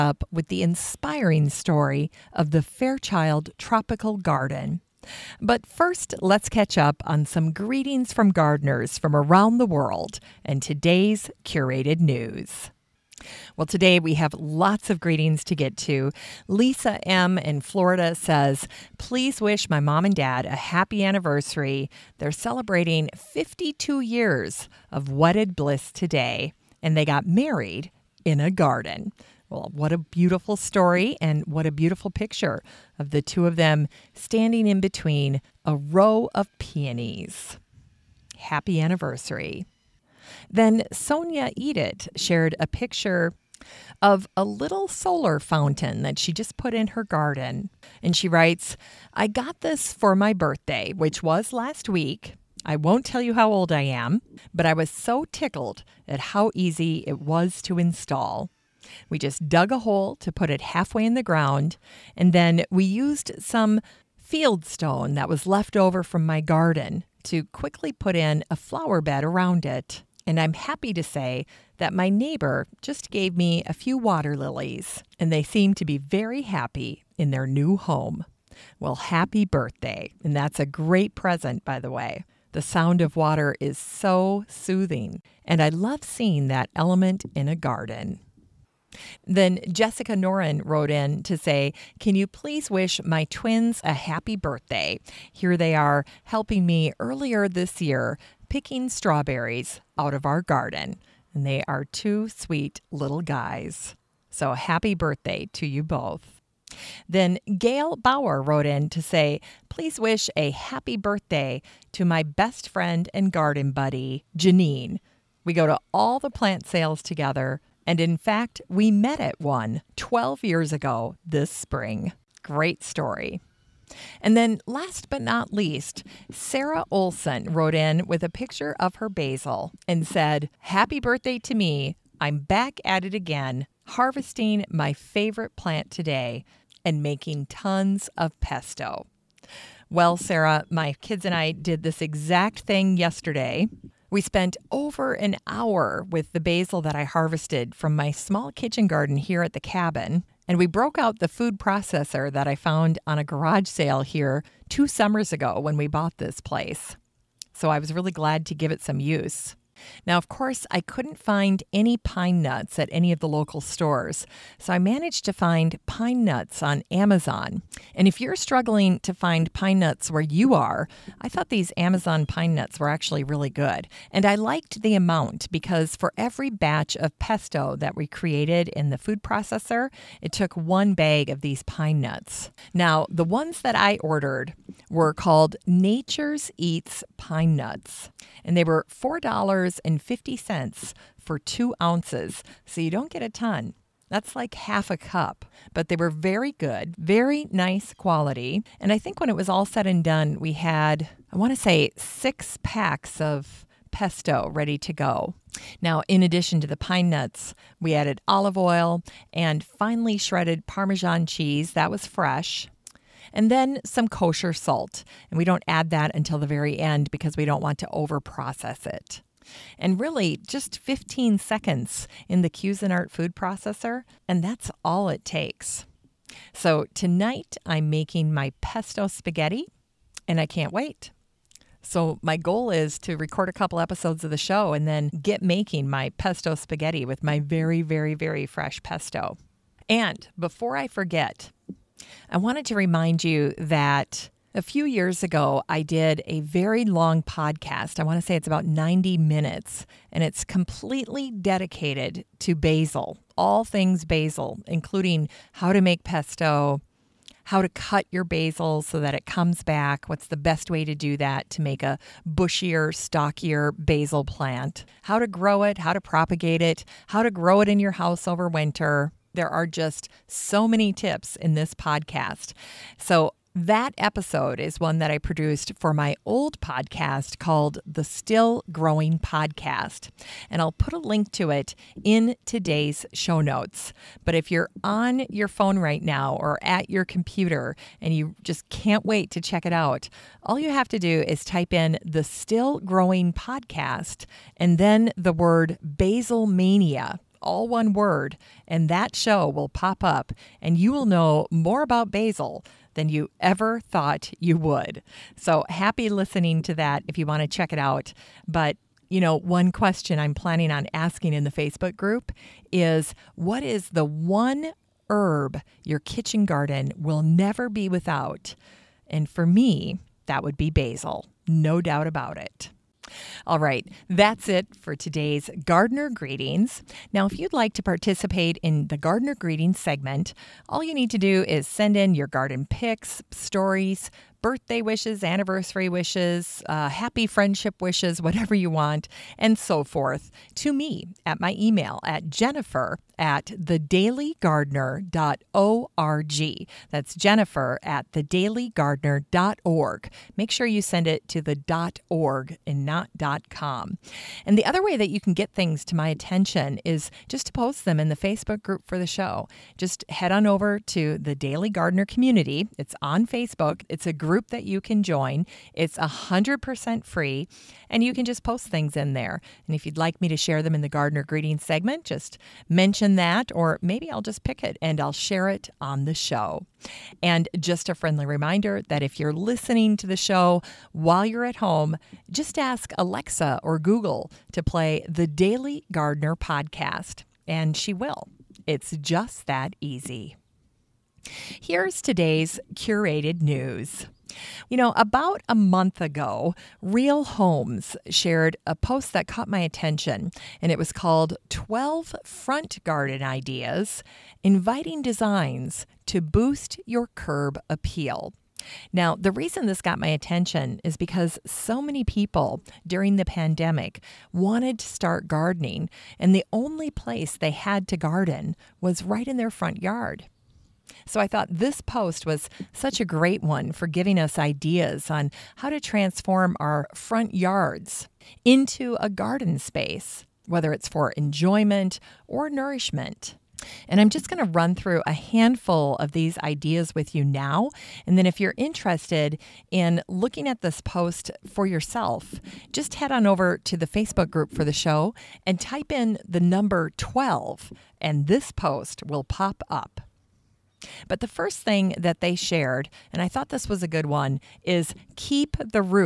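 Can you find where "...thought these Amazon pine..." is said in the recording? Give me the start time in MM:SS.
02:51.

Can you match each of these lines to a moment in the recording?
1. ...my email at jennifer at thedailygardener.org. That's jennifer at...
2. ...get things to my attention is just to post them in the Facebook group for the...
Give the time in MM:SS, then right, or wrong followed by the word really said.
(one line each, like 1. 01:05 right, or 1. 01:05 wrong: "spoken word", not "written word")
1. 05:41 right
2. 05:55 right.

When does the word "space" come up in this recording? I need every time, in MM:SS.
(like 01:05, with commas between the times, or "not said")
07:09.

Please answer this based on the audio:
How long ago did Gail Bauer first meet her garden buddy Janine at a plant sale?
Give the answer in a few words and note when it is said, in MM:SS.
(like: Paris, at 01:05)
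12 years, at 01:59.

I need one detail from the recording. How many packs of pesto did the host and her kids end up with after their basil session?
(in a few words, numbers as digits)
6.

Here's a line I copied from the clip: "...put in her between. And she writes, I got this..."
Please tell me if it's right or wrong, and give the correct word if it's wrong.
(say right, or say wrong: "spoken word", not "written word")
wrong: "garden", not "between".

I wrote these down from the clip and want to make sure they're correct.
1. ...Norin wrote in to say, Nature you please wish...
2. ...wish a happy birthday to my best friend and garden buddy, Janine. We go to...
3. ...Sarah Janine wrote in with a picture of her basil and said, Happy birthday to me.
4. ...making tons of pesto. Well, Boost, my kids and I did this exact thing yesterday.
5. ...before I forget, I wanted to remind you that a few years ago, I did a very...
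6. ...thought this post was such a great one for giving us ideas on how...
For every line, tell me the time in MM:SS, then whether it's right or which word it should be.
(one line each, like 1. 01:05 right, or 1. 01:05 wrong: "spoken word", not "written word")
1. 01:30 wrong: "Can", not "Nature"
2. 01:49 right
3. 02:06 wrong: "Olson", not "Janine"
4. 02:17 wrong: "Sarah", not "Boost"
5. 04:00 right
6. 07:01 right.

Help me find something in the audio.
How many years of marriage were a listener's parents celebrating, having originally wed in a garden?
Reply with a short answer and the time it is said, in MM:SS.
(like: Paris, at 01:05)
52, at 00:23.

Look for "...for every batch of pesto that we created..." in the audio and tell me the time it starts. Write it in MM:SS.
02:55.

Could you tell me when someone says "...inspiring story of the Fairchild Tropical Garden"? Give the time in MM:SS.
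00:00.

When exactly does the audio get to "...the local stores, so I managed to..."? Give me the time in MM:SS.
02:43.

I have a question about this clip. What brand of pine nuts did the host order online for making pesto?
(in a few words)
Nature's Eats.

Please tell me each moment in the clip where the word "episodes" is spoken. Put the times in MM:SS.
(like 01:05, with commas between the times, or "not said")
03:53, 04:33.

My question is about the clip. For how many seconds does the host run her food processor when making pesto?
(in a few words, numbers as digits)
15.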